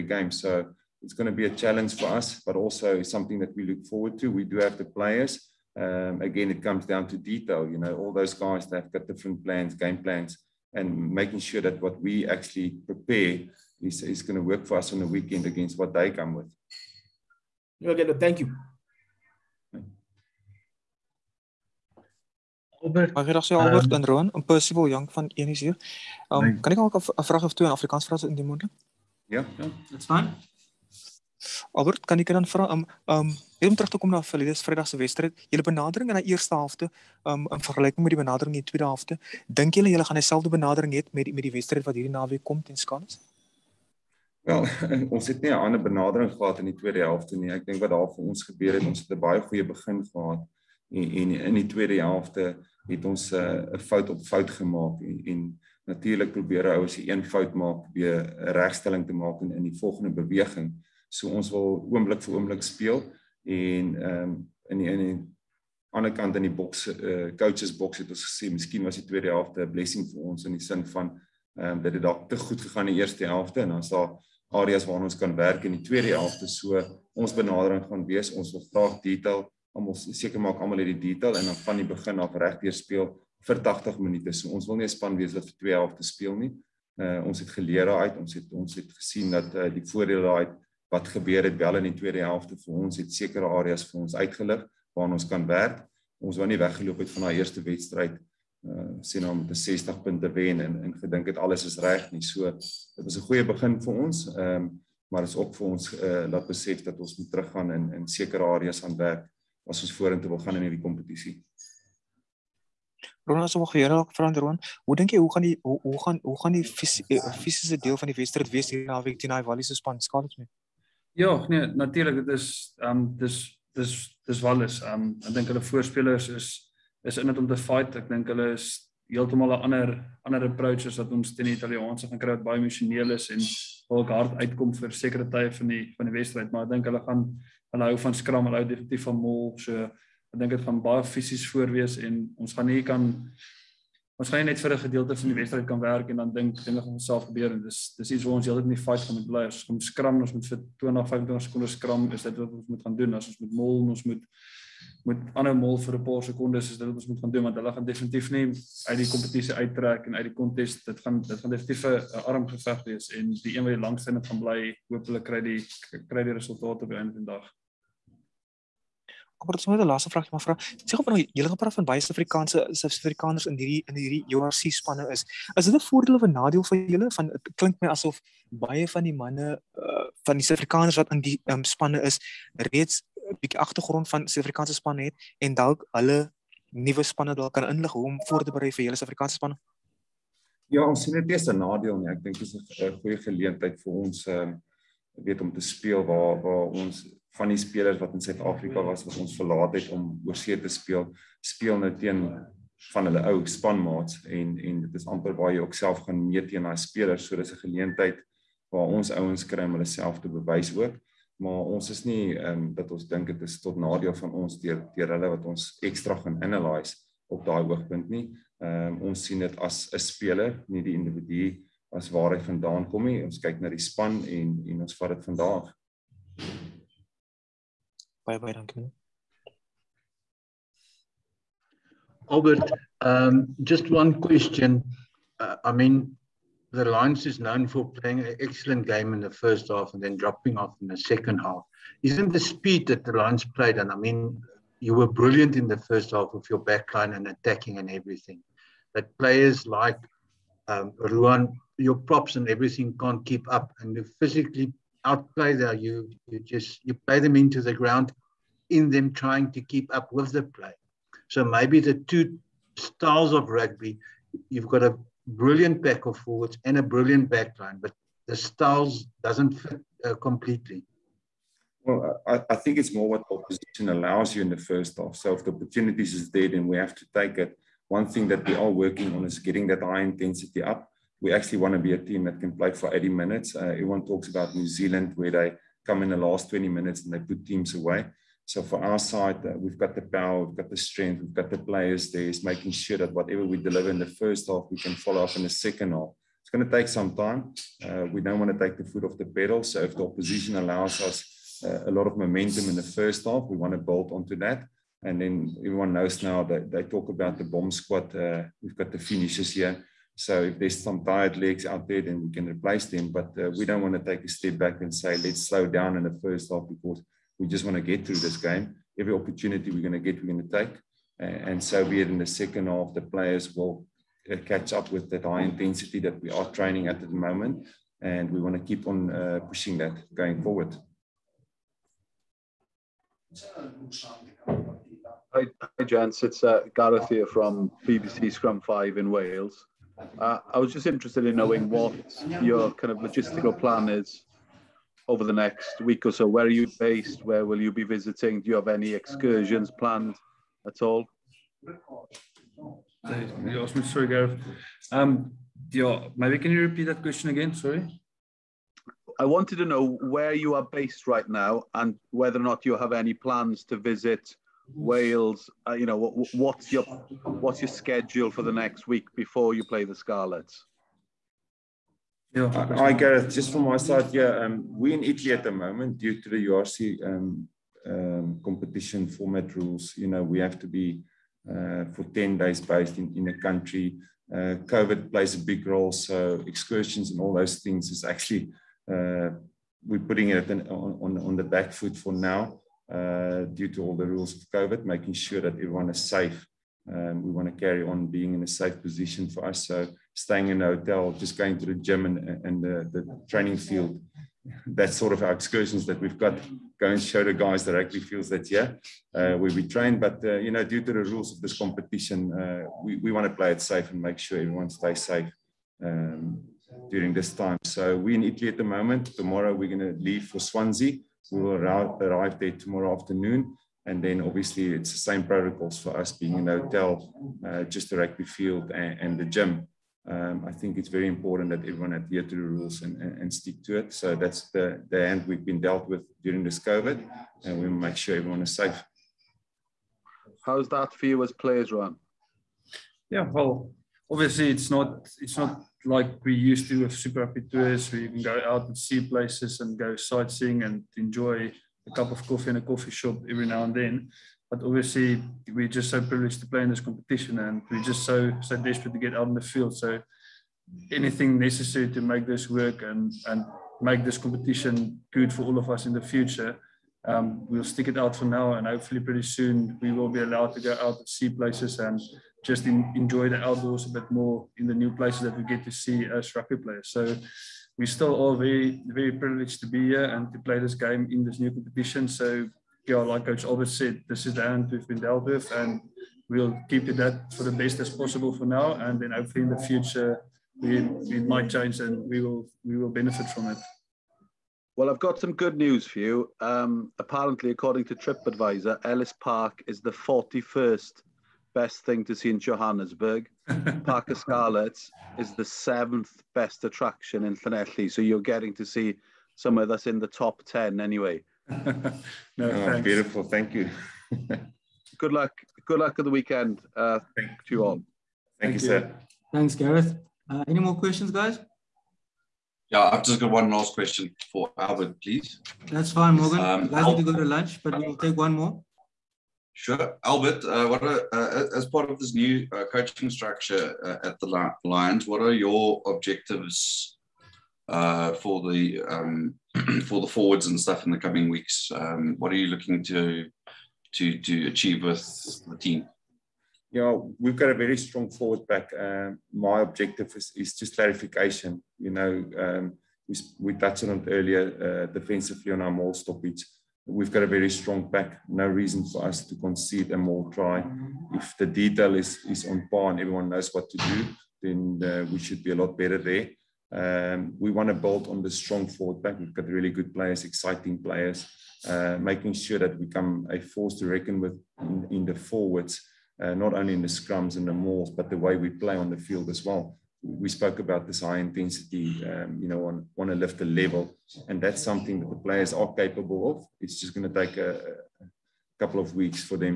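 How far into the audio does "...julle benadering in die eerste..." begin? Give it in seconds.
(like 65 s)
35 s.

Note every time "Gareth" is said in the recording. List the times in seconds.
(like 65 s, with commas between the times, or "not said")
336 s, 354 s, 372 s, 519 s.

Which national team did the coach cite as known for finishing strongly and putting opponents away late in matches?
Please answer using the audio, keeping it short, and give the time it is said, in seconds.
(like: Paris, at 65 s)
New Zealand, at 284 s.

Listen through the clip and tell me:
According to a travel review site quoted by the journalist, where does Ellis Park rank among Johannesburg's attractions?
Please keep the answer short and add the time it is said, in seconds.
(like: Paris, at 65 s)
41st, at 499 s.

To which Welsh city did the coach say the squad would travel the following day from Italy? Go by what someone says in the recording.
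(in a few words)
Swansea.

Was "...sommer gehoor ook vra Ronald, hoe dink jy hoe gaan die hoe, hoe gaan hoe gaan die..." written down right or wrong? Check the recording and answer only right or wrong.
right.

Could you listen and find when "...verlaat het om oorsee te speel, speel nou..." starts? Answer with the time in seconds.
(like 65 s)
199 s.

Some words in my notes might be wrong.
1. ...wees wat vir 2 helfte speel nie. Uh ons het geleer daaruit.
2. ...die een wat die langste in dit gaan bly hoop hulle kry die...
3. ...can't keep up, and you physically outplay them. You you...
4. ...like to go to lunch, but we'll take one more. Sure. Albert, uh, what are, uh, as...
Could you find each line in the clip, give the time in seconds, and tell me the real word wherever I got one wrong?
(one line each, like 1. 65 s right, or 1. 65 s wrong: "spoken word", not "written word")
1. 85 s right
2. 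163 s right
3. 252 s right
4. 526 s right.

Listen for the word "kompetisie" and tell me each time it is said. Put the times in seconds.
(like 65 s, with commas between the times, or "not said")
110 s, 159 s.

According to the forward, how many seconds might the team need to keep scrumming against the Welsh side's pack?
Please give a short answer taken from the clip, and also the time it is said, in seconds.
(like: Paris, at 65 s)
20 to 25 seconds, at 150 s.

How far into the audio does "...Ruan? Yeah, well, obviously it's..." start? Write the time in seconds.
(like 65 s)
441 s.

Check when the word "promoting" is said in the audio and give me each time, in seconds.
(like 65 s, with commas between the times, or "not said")
not said.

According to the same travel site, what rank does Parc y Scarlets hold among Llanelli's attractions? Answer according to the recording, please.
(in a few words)
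Seventh.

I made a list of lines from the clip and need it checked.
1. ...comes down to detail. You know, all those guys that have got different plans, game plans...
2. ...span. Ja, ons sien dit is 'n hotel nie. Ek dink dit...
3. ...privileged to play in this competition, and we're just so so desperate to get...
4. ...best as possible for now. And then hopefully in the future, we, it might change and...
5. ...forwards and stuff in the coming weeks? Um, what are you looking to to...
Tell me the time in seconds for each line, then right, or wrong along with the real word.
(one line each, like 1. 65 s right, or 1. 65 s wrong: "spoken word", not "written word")
1. 6 s right
2. 189 s wrong: "nadeel", not "hotel"
3. 456 s right
4. 487 s right
5. 540 s right.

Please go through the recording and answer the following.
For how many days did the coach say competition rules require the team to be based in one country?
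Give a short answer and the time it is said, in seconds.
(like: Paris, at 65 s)
10 days, at 382 s.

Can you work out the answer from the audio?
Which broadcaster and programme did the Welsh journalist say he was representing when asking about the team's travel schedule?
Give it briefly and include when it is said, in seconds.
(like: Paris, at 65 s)
BBC Scrum 5, at 337 s.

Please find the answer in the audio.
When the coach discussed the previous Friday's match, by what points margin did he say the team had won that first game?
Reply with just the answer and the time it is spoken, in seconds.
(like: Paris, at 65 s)
60 points, at 99 s.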